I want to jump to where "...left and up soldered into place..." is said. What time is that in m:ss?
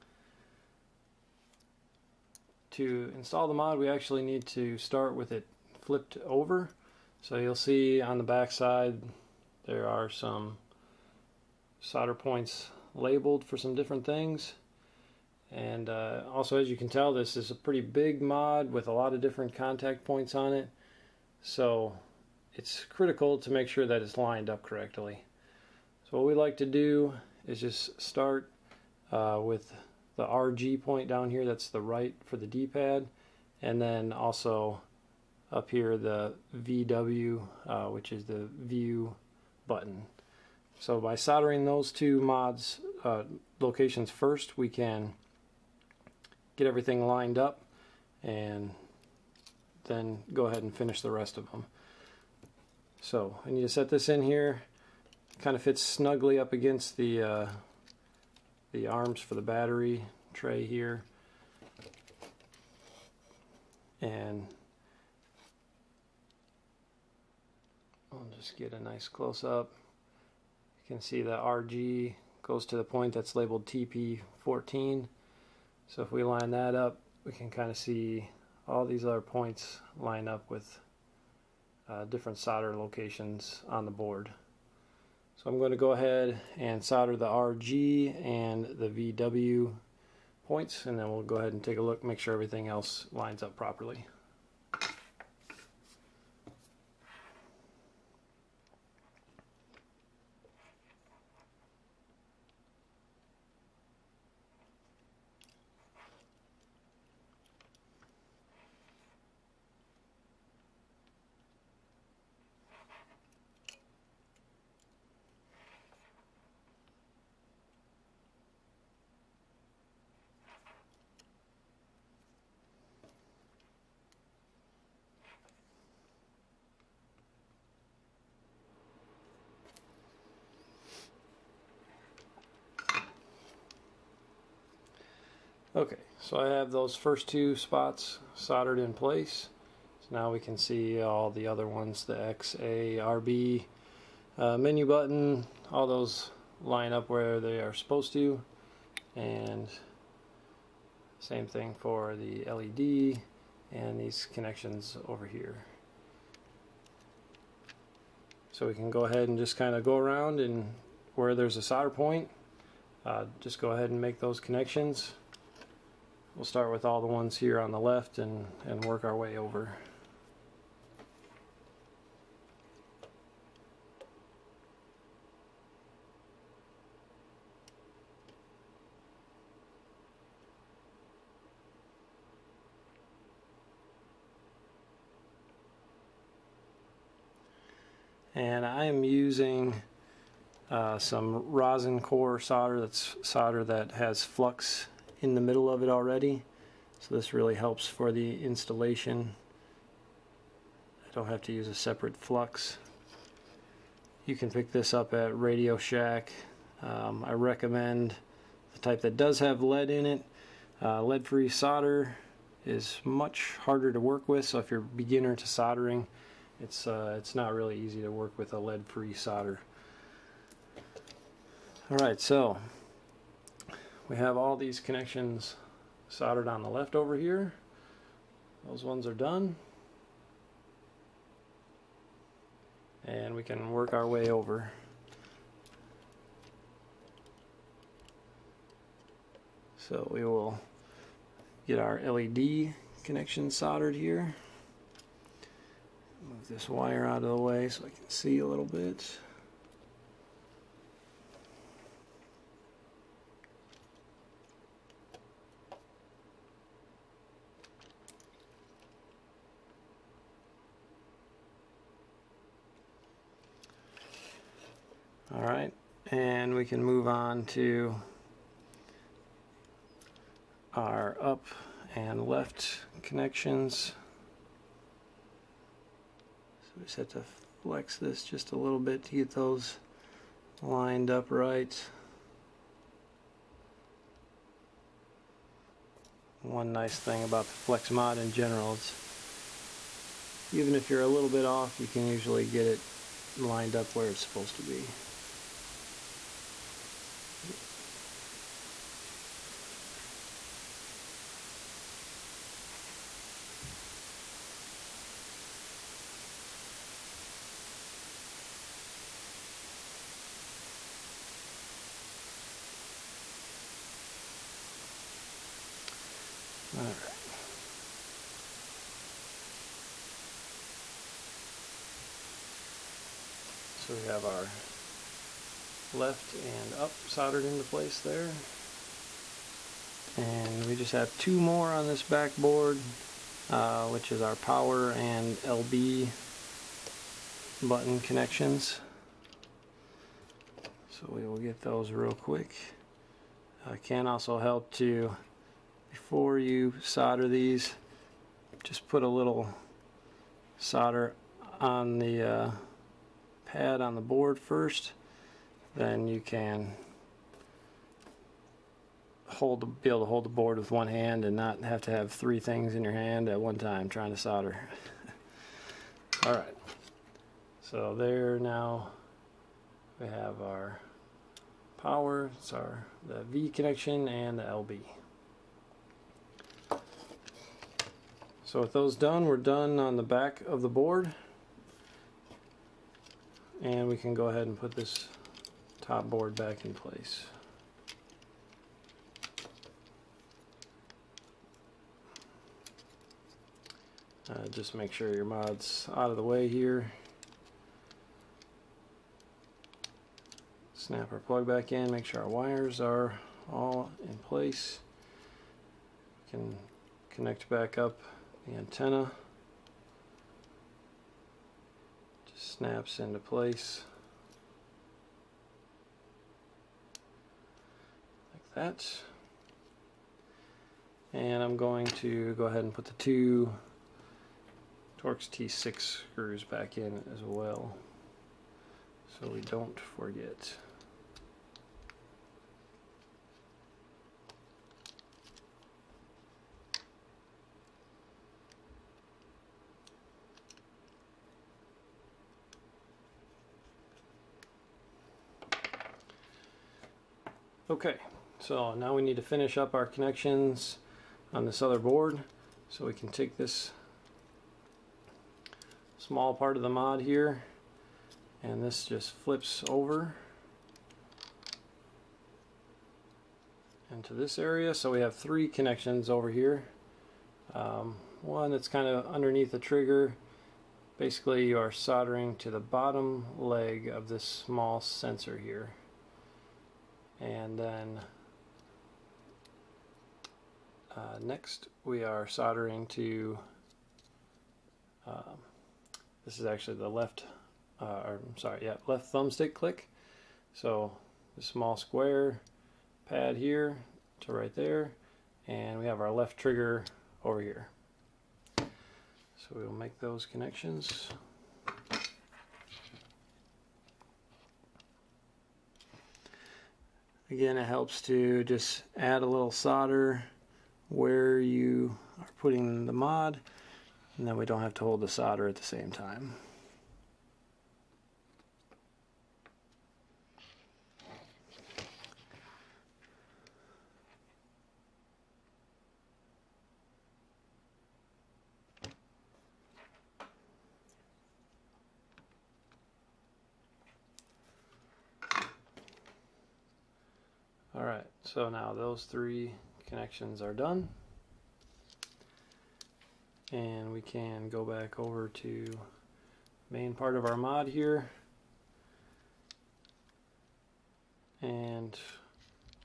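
5:25.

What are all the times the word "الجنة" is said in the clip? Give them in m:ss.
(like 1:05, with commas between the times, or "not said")
not said.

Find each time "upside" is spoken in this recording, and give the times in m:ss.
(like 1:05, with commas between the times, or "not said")
not said.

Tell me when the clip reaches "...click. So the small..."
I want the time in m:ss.
8:09.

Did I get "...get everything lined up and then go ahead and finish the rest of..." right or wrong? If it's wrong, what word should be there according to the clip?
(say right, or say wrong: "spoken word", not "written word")
right.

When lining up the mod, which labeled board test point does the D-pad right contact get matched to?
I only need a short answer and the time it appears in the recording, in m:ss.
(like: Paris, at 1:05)
TP14, at 1:13.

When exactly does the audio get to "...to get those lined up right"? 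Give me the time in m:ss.
4:39.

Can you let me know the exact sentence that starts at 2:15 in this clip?
Okay, so I have those first two spots soldered in place.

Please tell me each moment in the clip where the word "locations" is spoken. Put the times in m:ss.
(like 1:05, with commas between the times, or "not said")
0:43, 1:22.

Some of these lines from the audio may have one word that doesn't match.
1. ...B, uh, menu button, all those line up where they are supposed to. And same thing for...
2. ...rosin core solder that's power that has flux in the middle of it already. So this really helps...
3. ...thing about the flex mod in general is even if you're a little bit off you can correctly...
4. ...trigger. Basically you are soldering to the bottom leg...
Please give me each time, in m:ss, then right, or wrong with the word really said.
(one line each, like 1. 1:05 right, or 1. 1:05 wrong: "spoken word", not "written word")
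1. 2:23 right
2. 3:11 wrong: "solder", not "power"
3. 4:46 wrong: "usually", not "correctly"
4. 7:49 right.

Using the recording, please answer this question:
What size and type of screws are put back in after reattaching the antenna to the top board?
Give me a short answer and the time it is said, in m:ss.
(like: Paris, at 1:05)
Torx T6, at 7:05.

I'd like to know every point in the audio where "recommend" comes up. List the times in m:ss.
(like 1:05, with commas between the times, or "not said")
3:27.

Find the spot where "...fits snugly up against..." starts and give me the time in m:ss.
0:55.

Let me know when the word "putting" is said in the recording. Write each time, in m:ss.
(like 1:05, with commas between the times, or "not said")
8:32.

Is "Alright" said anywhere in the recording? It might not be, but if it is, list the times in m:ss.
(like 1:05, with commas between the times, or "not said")
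3:41, 8:57.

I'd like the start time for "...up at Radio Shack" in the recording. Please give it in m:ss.
3:24.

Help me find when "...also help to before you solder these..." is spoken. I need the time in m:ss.
5:44.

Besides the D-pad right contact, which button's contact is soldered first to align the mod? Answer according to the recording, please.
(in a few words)
View button.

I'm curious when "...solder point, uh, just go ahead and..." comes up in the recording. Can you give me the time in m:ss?
2:41.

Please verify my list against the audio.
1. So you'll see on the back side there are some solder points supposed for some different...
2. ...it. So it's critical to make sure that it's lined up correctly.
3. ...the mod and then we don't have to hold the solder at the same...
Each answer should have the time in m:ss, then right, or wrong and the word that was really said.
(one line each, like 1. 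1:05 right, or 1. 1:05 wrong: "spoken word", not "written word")
1. 0:07 wrong: "labeled", not "supposed"
2. 0:20 right
3. 8:32 right.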